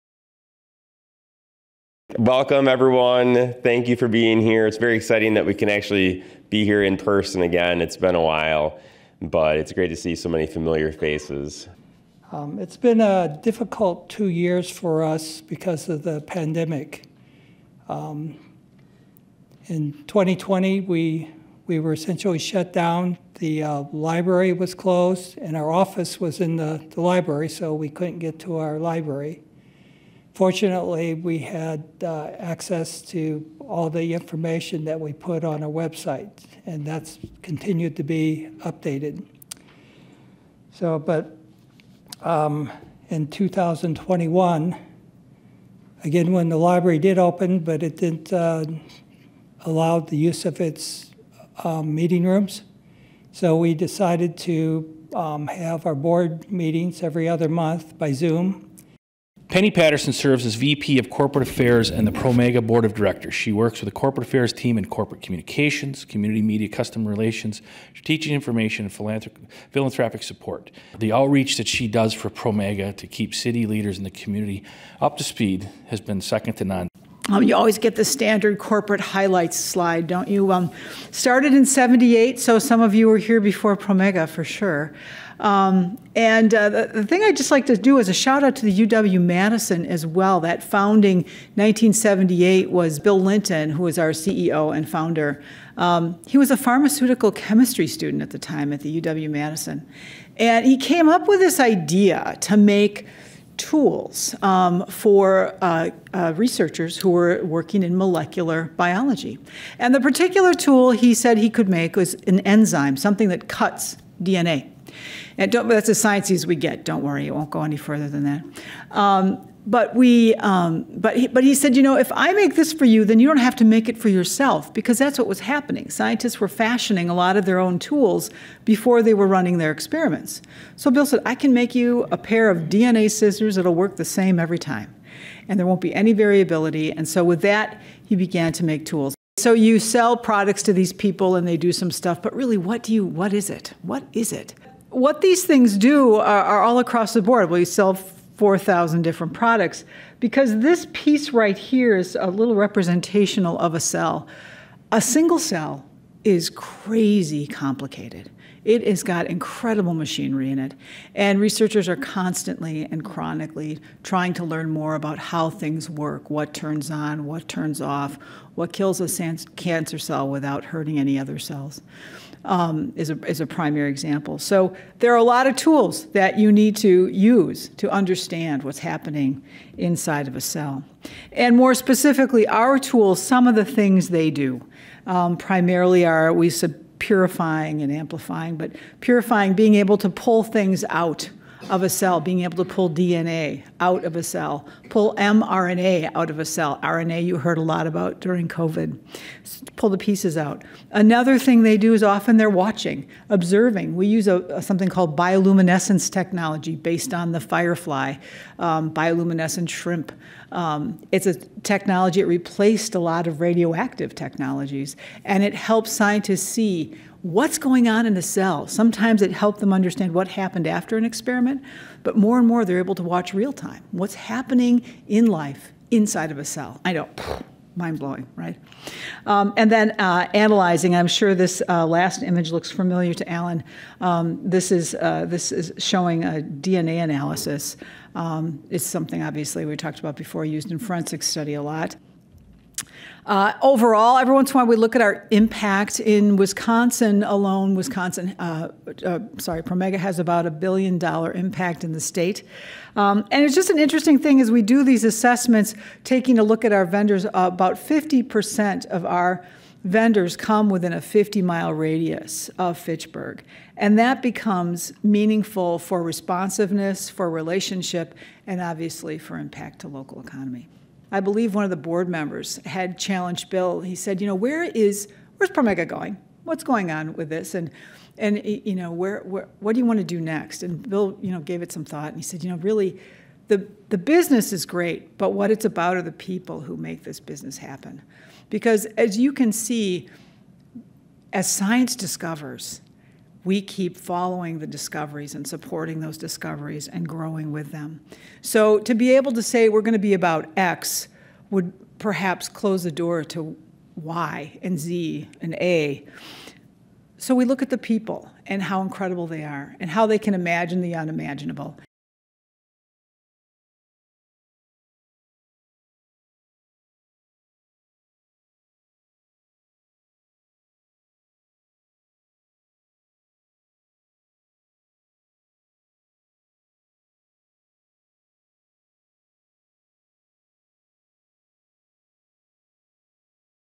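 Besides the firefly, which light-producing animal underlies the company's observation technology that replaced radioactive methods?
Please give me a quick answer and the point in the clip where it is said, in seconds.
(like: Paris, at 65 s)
bioluminescent shrimp, at 208 s.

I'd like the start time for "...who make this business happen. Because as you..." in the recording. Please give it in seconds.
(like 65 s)
286 s.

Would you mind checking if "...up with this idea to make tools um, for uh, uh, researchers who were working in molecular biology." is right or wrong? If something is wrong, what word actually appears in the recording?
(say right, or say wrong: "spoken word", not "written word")
right.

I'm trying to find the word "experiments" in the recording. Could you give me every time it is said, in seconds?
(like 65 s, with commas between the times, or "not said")
129 s, 221 s.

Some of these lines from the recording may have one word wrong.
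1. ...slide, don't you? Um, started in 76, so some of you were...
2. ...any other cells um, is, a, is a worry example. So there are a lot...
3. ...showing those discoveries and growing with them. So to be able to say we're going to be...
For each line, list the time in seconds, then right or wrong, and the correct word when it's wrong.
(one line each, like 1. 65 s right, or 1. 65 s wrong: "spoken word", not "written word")
1. 79 s wrong: "78", not "76"
2. 170 s wrong: "primary", not "worry"
3. 295 s wrong: "supporting", not "showing".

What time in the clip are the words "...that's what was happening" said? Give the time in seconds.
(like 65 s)
124 s.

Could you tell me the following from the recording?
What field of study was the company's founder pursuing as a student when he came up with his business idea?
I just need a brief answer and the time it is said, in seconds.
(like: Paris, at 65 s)
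pharmaceutical chemistry, at 96 s.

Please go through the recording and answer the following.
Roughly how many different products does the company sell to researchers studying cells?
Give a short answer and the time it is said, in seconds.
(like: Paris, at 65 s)
4,000, at 147 s.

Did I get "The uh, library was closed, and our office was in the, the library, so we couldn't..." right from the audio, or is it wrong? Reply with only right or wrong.
right.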